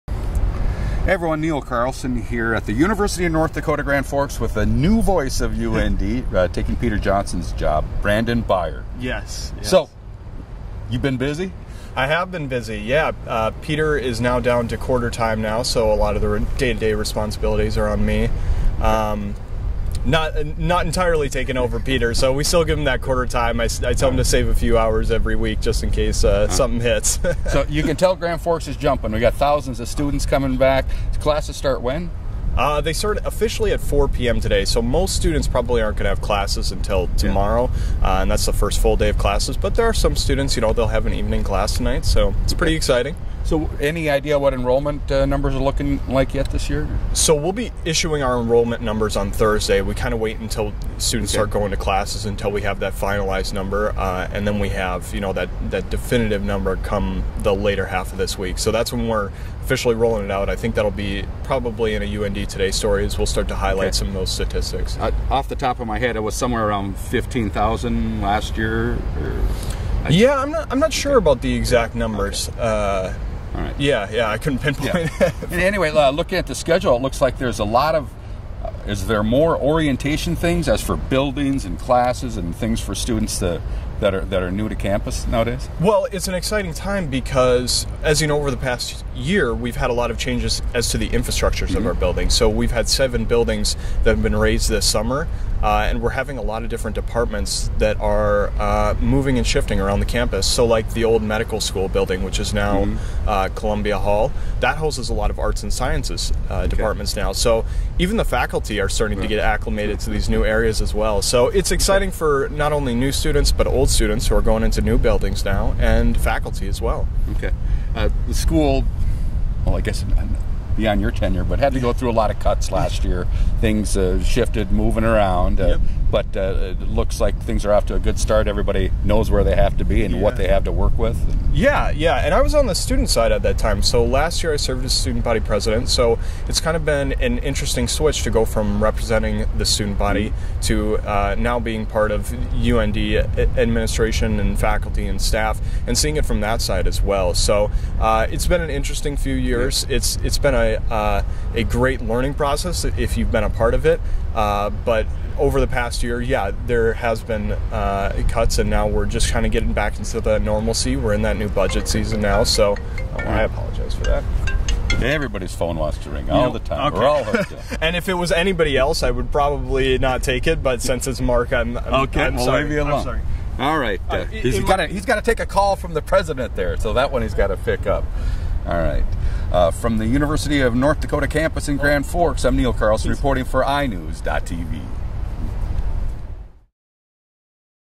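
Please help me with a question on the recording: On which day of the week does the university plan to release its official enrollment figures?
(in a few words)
Thursday.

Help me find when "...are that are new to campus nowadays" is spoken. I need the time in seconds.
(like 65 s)
84 s.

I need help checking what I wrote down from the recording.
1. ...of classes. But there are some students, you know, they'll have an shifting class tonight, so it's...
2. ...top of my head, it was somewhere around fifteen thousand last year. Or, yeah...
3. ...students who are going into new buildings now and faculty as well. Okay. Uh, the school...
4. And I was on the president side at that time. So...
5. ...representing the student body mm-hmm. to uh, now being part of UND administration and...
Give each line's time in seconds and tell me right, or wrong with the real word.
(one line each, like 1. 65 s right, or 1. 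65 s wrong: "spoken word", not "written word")
1. 39 s wrong: "evening", not "shifting"
2. 65 s right
3. 113 s right
4. 132 s wrong: "student", not "president"
5. 138 s right.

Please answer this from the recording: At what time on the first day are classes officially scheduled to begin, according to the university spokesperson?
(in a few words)
4 p.m.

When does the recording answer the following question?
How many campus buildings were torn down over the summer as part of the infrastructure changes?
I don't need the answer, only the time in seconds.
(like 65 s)
92 s.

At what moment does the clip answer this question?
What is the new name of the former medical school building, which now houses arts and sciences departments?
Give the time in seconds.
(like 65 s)
103 s.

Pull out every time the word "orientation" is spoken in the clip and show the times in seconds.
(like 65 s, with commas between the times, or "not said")
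79 s.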